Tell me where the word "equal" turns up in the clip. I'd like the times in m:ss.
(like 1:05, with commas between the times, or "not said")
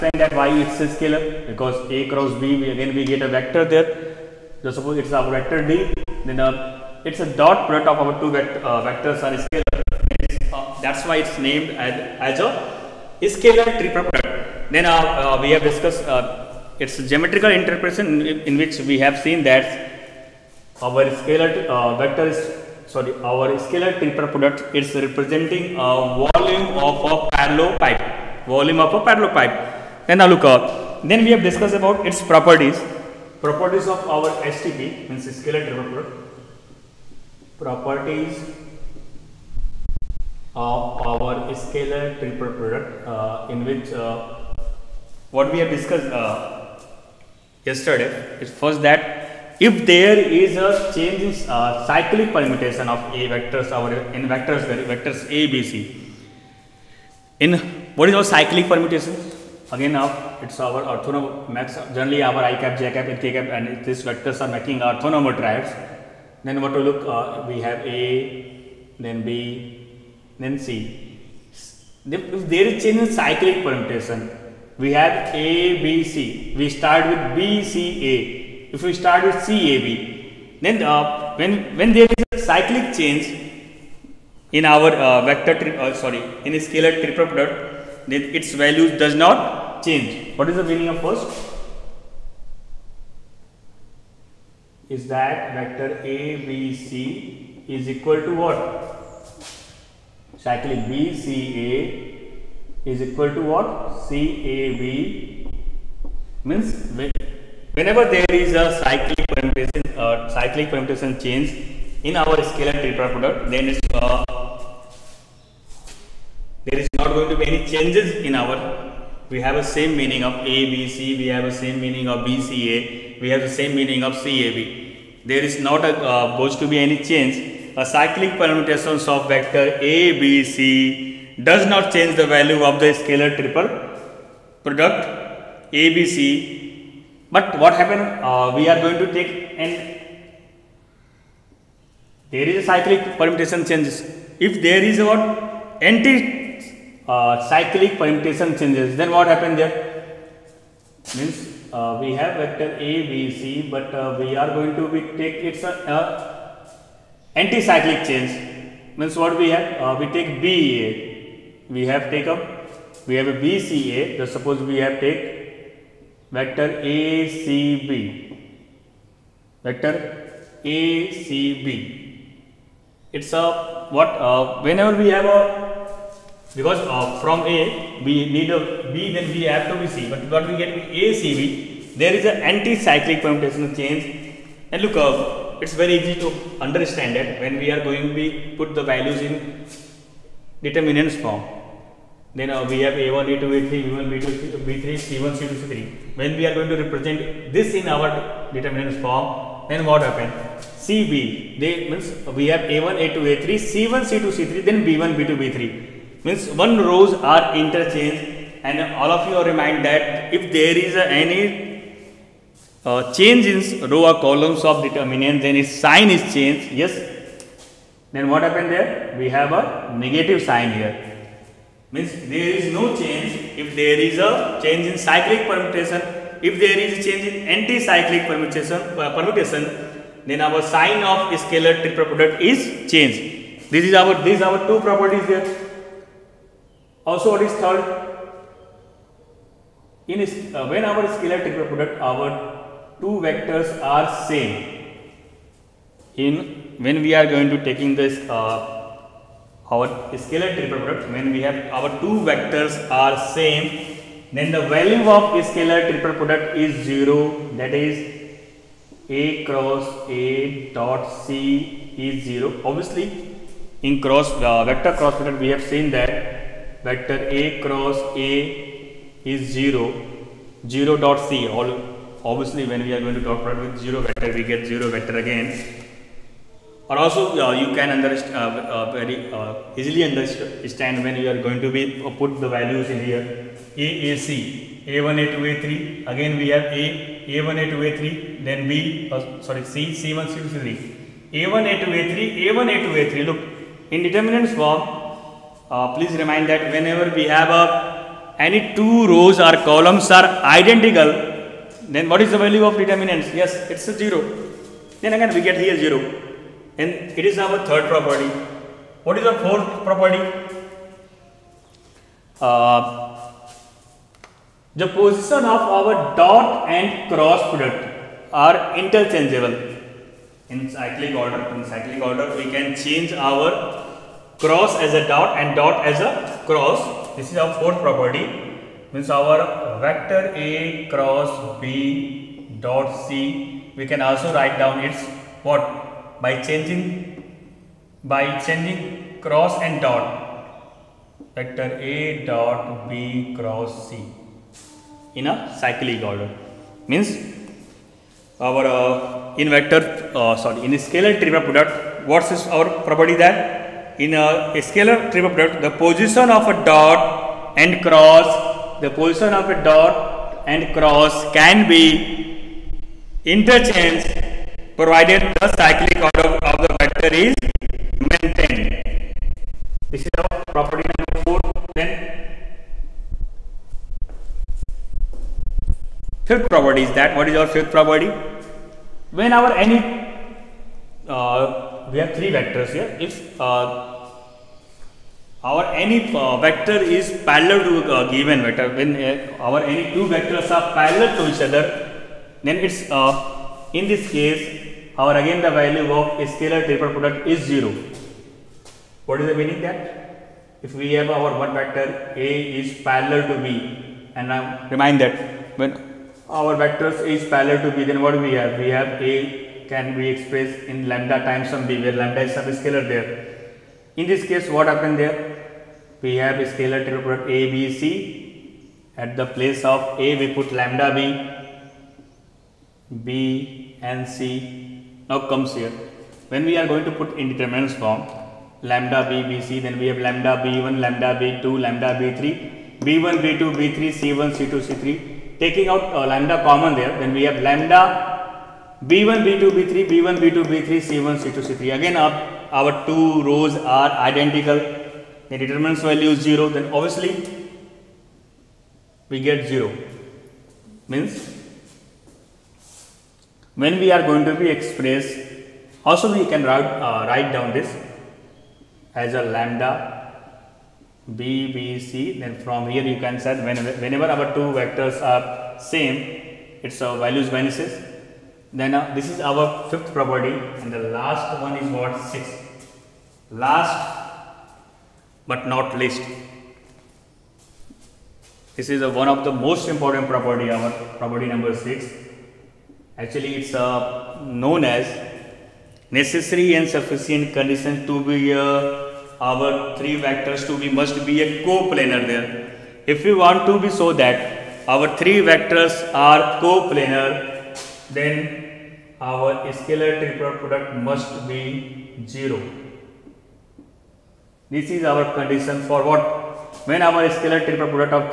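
1:37, 1:43.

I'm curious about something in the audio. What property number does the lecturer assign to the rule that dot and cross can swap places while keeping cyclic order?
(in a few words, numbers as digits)
4.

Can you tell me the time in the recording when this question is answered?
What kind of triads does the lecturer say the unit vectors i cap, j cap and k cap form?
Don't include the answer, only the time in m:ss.
1:04.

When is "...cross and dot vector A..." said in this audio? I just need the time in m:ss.
5:39.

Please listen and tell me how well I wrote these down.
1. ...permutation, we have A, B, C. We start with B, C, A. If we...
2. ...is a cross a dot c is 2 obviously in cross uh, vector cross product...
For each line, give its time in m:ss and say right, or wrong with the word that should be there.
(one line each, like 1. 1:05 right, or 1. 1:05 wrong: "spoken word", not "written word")
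1. 1:13 right
2. 4:17 wrong: "0", not "2".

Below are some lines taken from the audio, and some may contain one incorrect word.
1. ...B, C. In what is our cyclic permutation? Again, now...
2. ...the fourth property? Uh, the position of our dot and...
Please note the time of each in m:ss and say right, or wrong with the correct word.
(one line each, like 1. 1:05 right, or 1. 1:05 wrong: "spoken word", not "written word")
1. 0:55 right
2. 5:09 right.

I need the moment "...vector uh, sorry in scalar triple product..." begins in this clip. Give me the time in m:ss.
5:49.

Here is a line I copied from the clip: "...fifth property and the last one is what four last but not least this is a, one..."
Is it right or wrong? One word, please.
wrong.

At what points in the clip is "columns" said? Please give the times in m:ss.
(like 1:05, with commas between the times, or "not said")
3:34, 4:59.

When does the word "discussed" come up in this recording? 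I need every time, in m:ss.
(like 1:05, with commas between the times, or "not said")
0:15, 0:31, 0:45.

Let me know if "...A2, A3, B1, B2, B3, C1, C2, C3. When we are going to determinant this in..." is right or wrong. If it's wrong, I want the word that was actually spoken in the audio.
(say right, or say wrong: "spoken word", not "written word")
wrong: "represent", not "determinant".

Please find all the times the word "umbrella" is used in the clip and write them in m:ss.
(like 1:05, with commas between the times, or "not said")
not said.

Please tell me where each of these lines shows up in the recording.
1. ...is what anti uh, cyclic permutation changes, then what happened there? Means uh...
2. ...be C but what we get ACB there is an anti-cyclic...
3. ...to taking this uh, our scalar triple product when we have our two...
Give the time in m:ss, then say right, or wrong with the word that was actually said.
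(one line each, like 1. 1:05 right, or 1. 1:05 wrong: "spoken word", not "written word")
1. 2:24 right
2. 2:59 right
3. 4:07 right.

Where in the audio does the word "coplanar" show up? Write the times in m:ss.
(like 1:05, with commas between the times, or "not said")
8:11, 8:16.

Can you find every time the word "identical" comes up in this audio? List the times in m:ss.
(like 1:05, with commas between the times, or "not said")
5:00, 7:24.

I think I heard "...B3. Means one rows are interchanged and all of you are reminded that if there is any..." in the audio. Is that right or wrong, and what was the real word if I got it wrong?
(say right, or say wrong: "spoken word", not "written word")
right.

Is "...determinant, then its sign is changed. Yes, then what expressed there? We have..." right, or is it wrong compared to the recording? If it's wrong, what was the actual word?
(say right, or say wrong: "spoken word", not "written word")
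wrong: "happened", not "expressed".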